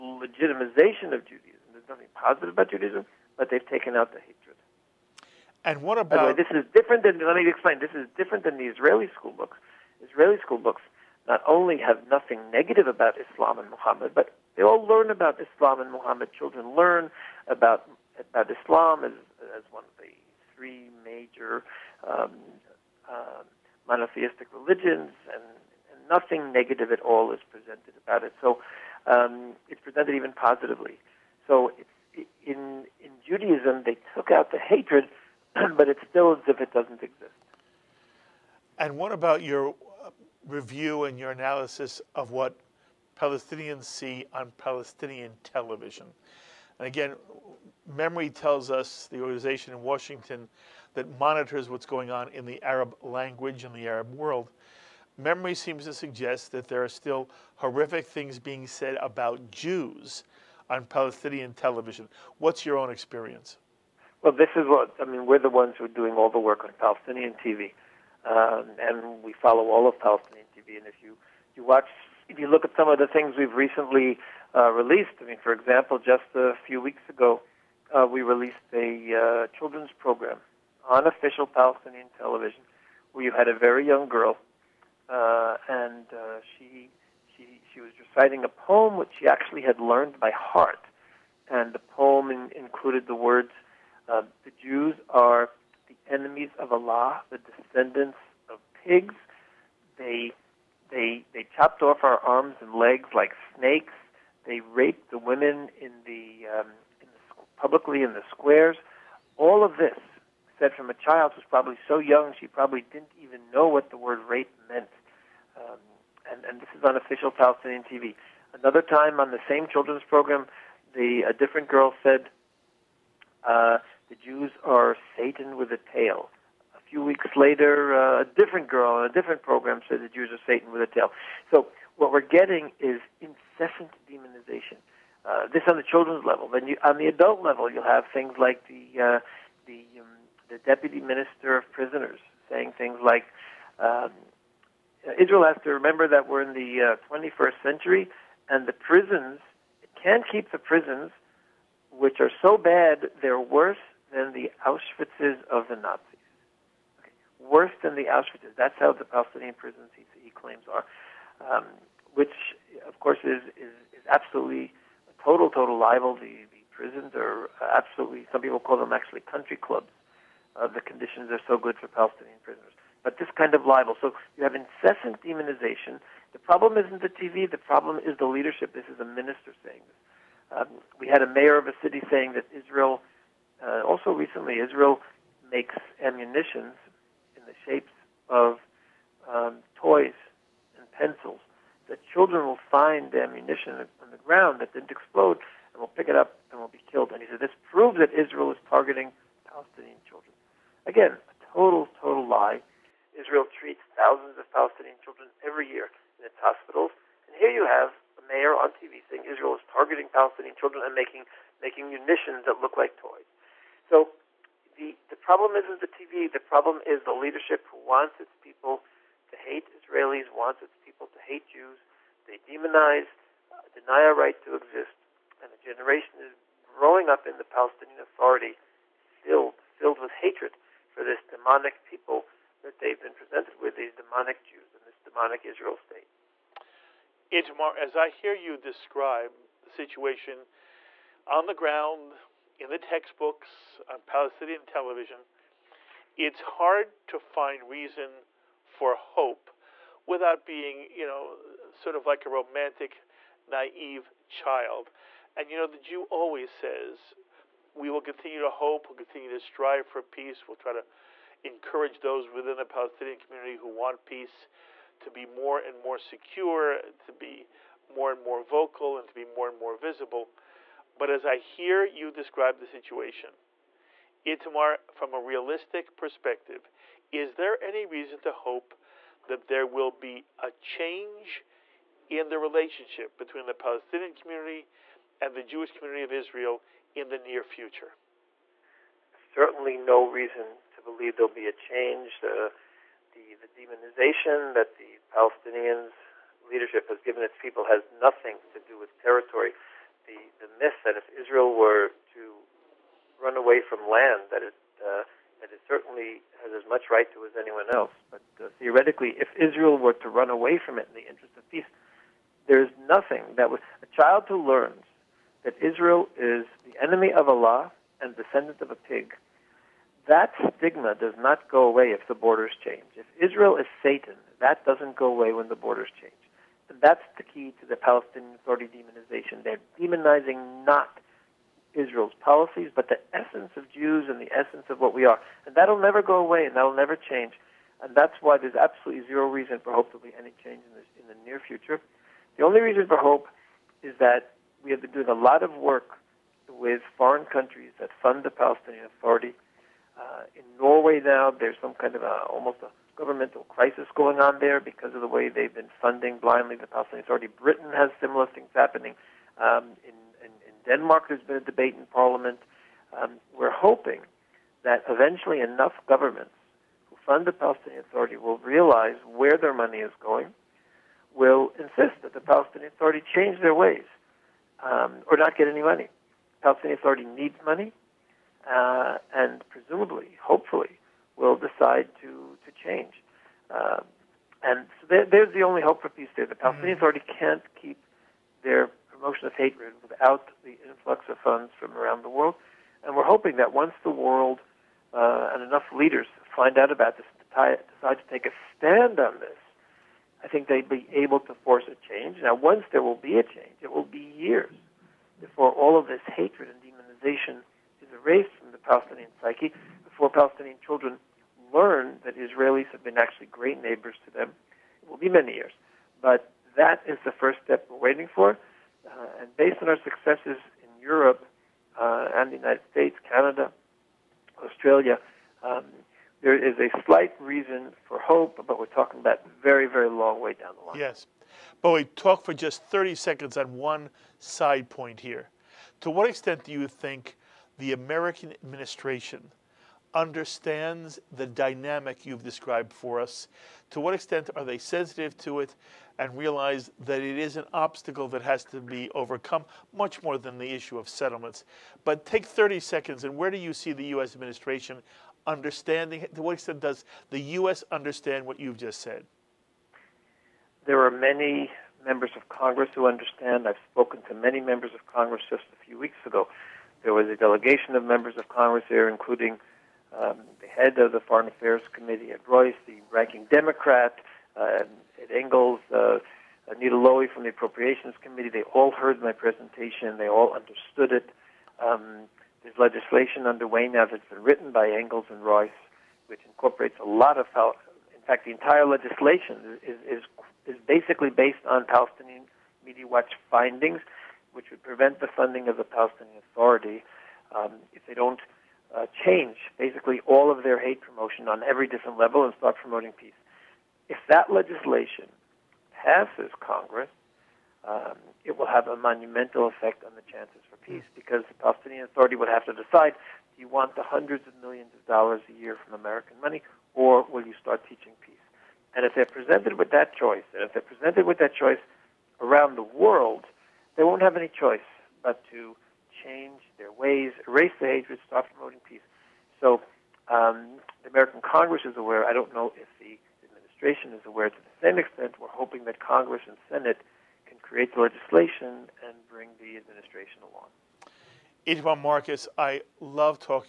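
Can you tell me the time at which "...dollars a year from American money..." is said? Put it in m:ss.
8:34.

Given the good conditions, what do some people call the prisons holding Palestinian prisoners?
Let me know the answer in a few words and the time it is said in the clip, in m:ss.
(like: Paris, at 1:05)
Country clubs, at 2:49.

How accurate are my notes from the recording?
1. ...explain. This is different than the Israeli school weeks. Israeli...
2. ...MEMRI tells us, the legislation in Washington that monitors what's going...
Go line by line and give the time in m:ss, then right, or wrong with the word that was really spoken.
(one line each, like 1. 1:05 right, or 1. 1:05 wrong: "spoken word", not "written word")
1. 0:07 wrong: "books", not "weeks"
2. 0:47 wrong: "organization", not "legislation".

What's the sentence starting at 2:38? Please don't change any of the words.
That's how the Palestinian prisons he, he claims are, um, which of course is, is, is absolutely a total total libel.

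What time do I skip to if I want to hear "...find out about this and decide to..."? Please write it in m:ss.
6:36.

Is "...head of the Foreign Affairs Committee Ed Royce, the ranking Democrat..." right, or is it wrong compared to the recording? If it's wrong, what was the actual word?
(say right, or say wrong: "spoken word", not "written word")
right.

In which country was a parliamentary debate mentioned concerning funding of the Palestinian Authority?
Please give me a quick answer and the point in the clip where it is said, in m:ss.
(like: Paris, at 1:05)
Denmark, at 6:00.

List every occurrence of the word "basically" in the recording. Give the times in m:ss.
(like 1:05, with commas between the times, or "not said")
8:10, 8:19.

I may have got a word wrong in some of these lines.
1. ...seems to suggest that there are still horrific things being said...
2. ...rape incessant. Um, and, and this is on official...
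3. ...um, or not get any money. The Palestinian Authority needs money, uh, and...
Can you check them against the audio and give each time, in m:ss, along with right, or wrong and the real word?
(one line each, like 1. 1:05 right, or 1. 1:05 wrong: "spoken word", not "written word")
1. 0:55 right
2. 1:54 wrong: "meant", not "incessant"
3. 6:14 right.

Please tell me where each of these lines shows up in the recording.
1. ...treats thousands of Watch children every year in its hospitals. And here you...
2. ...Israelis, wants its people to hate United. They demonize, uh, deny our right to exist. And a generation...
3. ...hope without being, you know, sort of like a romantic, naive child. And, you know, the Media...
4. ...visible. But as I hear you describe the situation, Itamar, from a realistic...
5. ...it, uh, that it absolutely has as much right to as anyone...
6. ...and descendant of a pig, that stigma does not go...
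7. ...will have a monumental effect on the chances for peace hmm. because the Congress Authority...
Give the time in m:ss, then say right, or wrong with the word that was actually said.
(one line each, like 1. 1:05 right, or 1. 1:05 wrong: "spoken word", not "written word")
1. 3:23 wrong: "Palestinian", not "Watch"
2. 3:39 wrong: "Jews", not "United"
3. 4:08 wrong: "Jew", not "Media"
4. 4:29 right
5. 5:04 wrong: "certainly", not "absolutely"
6. 5:17 right
7. 8:28 wrong: "Palestinian", not "Congress".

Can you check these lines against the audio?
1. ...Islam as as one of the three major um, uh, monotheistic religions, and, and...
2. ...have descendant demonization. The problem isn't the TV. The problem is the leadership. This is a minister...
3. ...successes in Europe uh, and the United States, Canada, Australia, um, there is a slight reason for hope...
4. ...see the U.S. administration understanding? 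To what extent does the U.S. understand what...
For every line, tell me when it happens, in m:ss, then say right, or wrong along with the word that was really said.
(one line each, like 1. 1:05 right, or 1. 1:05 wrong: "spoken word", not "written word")
1. 0:18 right
2. 2:54 wrong: "incessant", not "descendant"
3. 6:59 right
4. 7:33 right.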